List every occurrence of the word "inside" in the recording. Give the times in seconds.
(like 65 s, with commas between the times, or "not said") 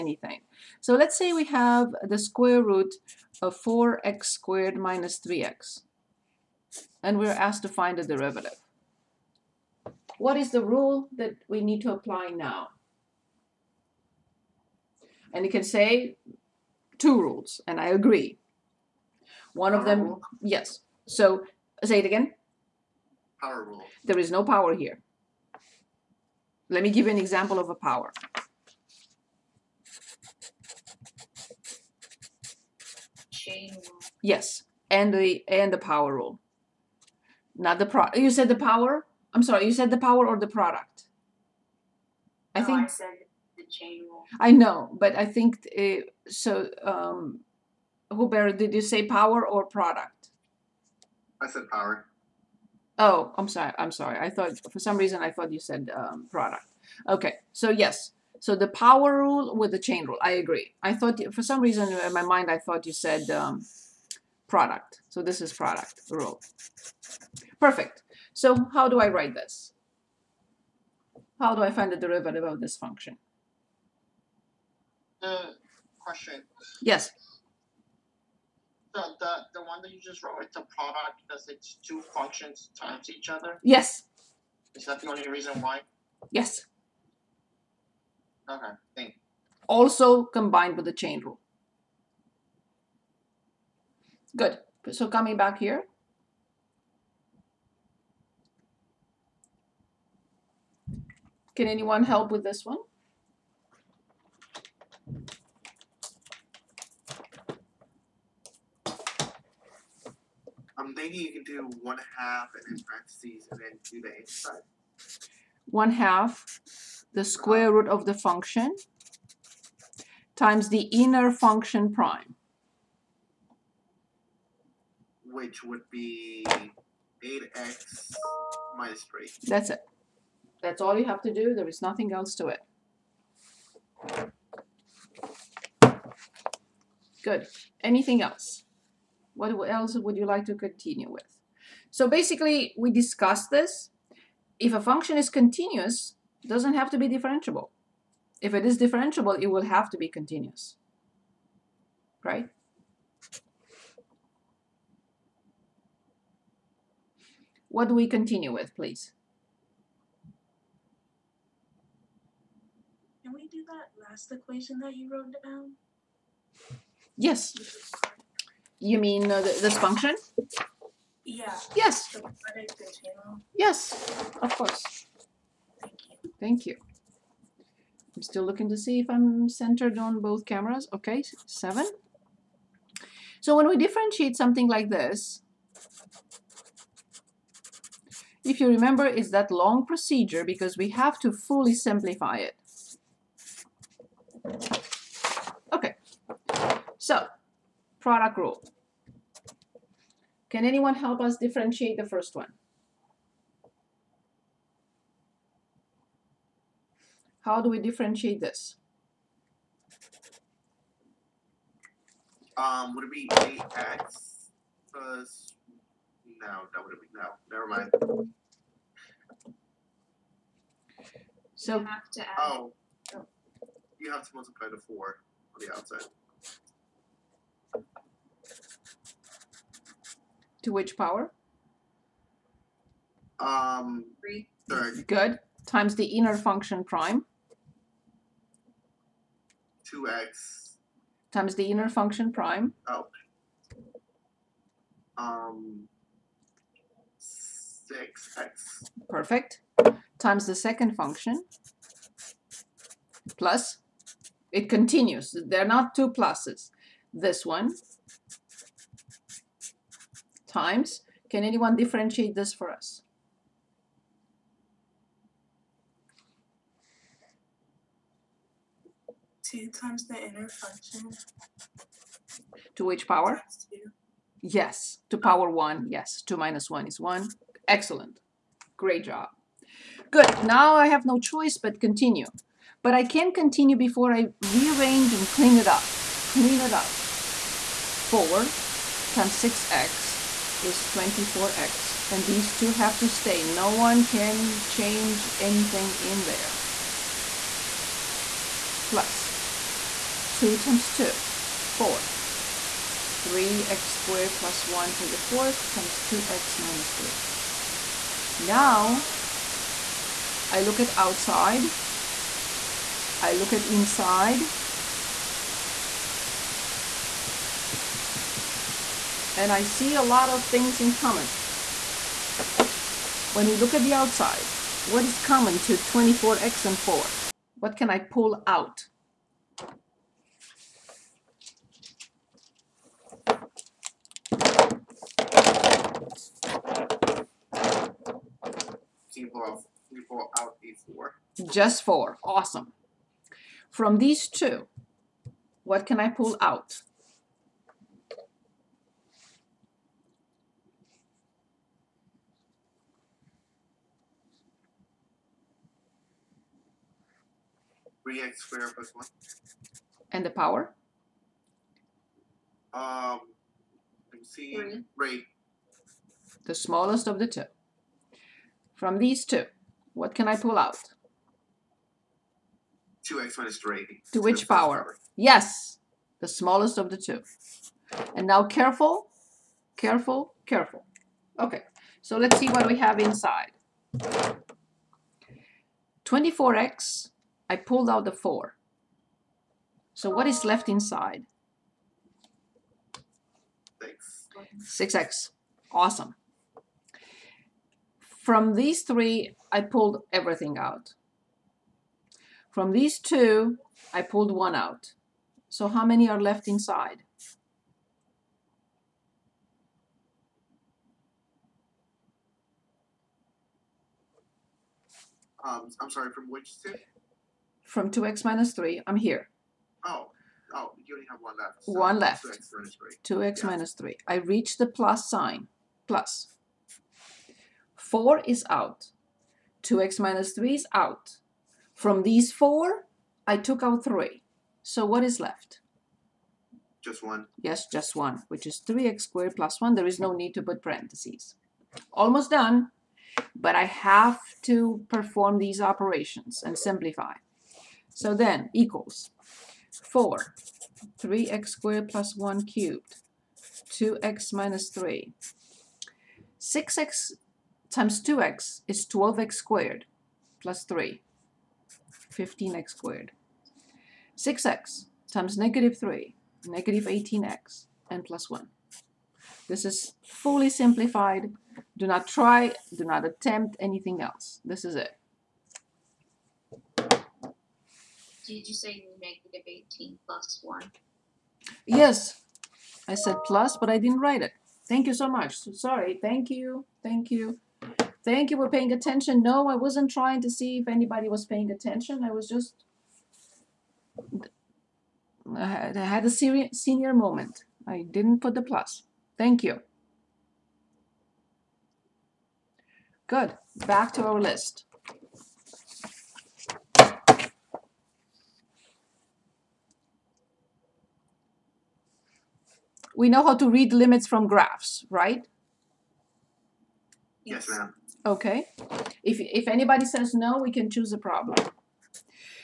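114 s, 313 s, 382 s, 390 s, 406 s.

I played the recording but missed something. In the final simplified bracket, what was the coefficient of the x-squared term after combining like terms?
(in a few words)
15.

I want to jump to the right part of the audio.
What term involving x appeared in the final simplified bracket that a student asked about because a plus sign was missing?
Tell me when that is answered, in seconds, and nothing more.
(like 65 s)
466 s.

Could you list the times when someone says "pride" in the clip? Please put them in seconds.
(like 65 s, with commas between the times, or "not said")
not said.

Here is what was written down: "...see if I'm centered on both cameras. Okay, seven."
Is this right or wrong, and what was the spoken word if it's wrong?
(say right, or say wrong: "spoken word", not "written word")
right.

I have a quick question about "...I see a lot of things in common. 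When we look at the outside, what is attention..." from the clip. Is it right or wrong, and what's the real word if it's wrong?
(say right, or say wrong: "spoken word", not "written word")
wrong: "common", not "attention".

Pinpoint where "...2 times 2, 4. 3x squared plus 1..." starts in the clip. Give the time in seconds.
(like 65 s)
300 s.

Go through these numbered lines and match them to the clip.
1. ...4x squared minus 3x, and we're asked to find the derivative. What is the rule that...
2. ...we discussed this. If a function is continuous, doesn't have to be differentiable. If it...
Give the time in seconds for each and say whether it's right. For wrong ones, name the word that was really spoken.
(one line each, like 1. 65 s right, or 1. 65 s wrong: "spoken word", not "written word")
1. 3 s right
2. 142 s right.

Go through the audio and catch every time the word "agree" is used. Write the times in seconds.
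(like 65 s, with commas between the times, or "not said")
17 s, 60 s.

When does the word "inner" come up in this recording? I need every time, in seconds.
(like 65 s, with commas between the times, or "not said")
120 s, 236 s, 241 s, 270 s.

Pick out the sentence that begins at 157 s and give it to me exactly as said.
What do we continue with, please?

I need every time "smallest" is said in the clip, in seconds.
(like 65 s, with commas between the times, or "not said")
366 s, 376 s.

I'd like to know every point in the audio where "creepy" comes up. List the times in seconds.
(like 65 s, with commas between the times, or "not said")
not said.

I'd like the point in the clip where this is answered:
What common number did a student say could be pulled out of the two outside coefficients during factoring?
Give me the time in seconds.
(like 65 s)
341 s.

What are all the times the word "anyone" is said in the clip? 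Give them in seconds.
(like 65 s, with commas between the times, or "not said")
101 s, 200 s, 261 s.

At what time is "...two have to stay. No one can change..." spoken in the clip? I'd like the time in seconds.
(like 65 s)
292 s.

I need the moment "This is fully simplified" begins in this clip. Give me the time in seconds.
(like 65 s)
469 s.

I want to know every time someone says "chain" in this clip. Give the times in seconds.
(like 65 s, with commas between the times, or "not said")
33 s, 43 s, 59 s, 90 s.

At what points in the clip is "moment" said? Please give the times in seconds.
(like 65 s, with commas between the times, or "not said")
496 s.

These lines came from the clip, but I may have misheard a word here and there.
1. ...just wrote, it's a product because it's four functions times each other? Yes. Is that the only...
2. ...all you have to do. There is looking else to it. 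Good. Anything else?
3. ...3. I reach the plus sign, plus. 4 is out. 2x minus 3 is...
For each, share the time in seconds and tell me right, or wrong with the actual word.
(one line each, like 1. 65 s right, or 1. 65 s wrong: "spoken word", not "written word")
1. 79 s wrong: "two", not "four"
2. 130 s wrong: "nothing", not "looking"
3. 423 s right.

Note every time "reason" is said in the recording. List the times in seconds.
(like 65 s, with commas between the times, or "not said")
54 s, 61 s, 85 s.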